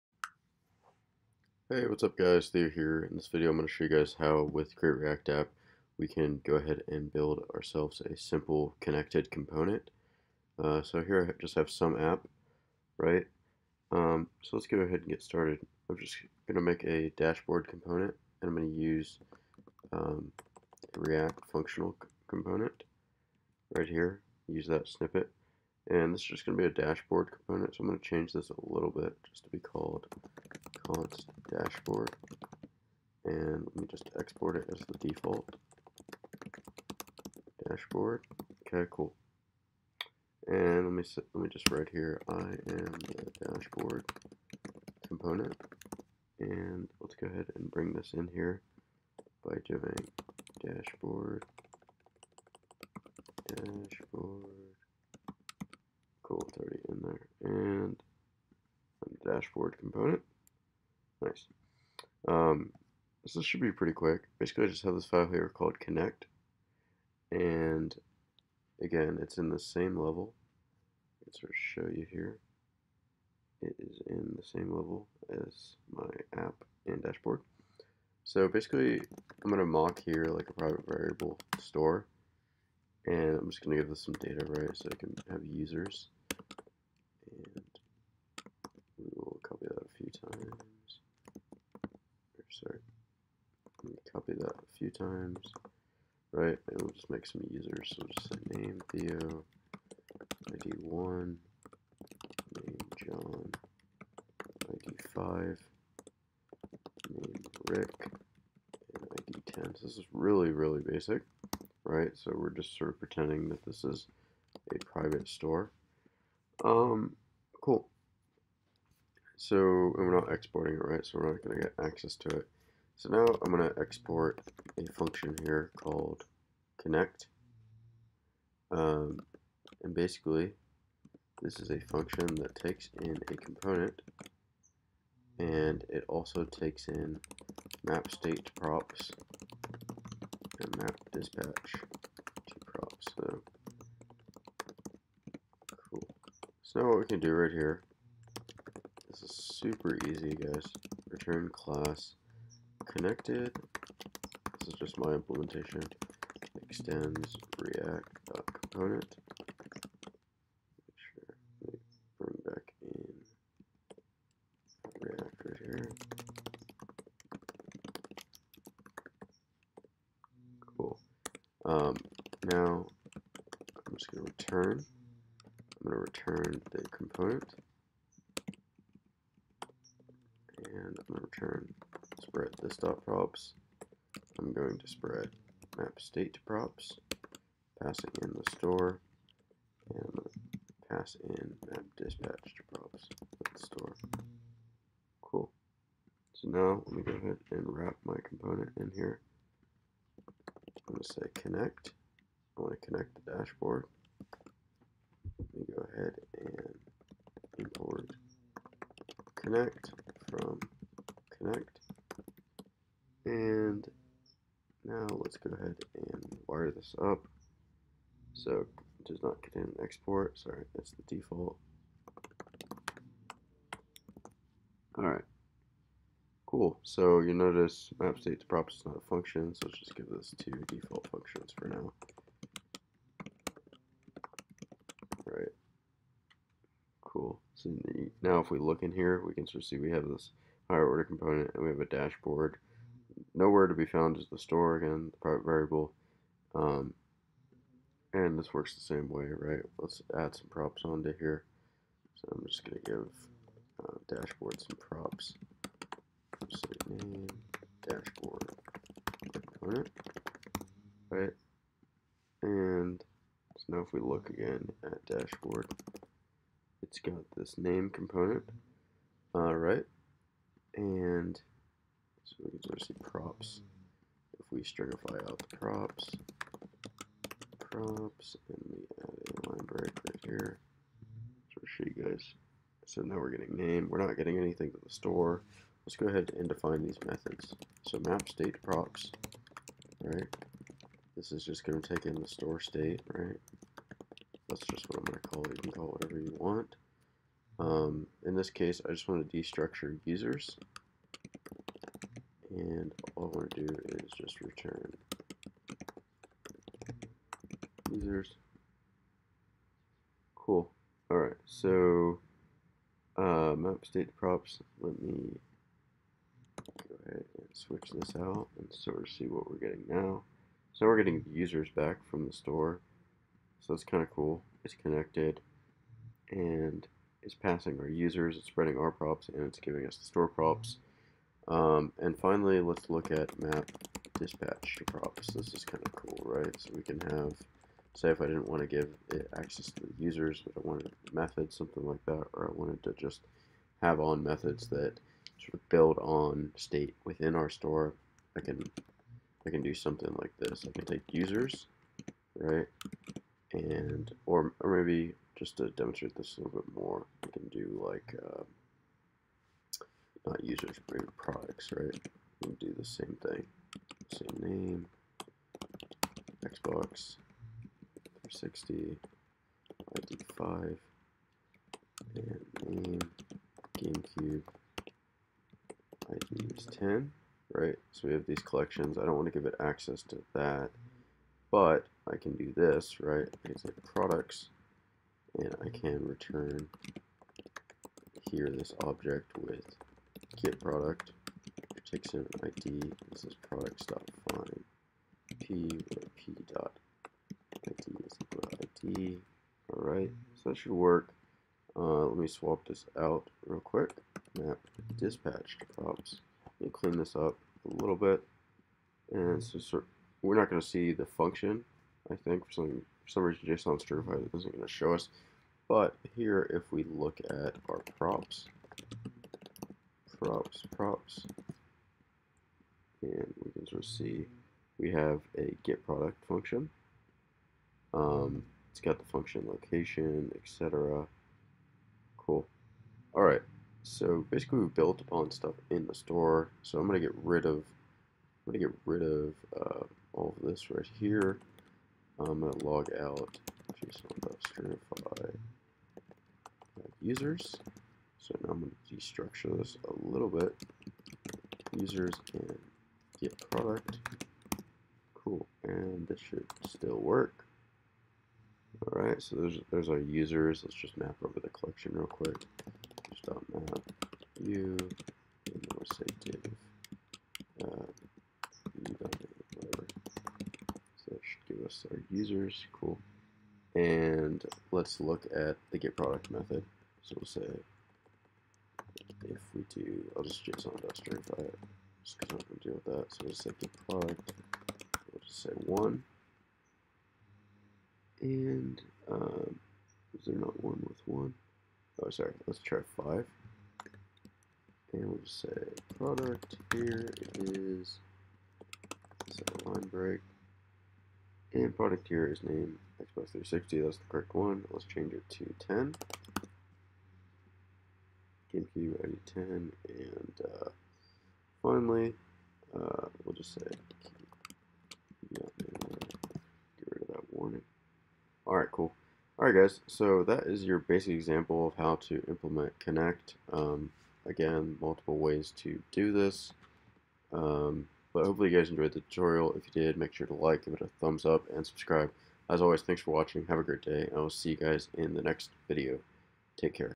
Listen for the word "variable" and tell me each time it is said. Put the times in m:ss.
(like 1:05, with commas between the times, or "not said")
1:20, 4:05.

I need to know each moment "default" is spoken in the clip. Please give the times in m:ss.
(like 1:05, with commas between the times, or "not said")
0:35, 3:41, 3:50.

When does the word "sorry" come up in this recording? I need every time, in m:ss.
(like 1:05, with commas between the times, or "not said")
3:40, 8:12.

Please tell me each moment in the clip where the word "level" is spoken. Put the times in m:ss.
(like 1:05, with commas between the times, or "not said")
1:09, 1:14.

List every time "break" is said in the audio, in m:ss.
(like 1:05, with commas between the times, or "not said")
4:39, 8:19.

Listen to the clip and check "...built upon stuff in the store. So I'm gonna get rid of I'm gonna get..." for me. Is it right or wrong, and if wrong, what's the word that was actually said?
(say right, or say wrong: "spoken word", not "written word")
right.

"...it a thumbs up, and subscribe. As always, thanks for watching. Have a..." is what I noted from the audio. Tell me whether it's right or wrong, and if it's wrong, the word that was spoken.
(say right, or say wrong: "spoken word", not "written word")
right.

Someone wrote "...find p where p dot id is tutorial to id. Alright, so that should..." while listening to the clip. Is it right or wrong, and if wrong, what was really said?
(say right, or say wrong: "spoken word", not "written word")
wrong: "equal", not "tutorial".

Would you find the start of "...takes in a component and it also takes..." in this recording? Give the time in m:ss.
2:12.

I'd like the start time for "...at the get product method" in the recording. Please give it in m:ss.
7:55.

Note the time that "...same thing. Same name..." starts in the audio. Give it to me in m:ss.
6:02.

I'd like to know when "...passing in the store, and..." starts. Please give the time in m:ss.
3:07.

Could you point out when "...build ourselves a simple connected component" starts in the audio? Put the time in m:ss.
0:07.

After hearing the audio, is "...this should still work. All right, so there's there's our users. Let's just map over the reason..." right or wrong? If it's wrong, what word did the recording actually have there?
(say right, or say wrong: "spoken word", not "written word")
wrong: "collection", not "reason".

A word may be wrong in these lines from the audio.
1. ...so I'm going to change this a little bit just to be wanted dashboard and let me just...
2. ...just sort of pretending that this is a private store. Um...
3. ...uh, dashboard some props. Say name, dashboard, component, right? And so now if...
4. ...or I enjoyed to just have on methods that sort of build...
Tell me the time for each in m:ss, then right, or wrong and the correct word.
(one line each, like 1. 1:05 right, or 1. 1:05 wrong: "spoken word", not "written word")
1. 0:27 wrong: "called", not "wanted"
2. 1:52 right
3. 4:13 right
4. 5:42 wrong: "wanted", not "enjoyed".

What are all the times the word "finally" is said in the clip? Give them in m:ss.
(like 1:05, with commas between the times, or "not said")
5:32, 8:31.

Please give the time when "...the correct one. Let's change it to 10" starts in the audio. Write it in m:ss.
8:23.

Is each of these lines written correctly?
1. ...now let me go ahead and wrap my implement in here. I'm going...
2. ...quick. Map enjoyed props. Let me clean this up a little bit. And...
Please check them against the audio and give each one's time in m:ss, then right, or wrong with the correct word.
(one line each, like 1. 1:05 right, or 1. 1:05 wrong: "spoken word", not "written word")
1. 3:16 wrong: "component", not "implement"
2. 6:43 wrong: "dispatched", not "enjoyed".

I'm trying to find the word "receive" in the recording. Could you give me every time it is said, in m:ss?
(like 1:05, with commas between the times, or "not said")
not said.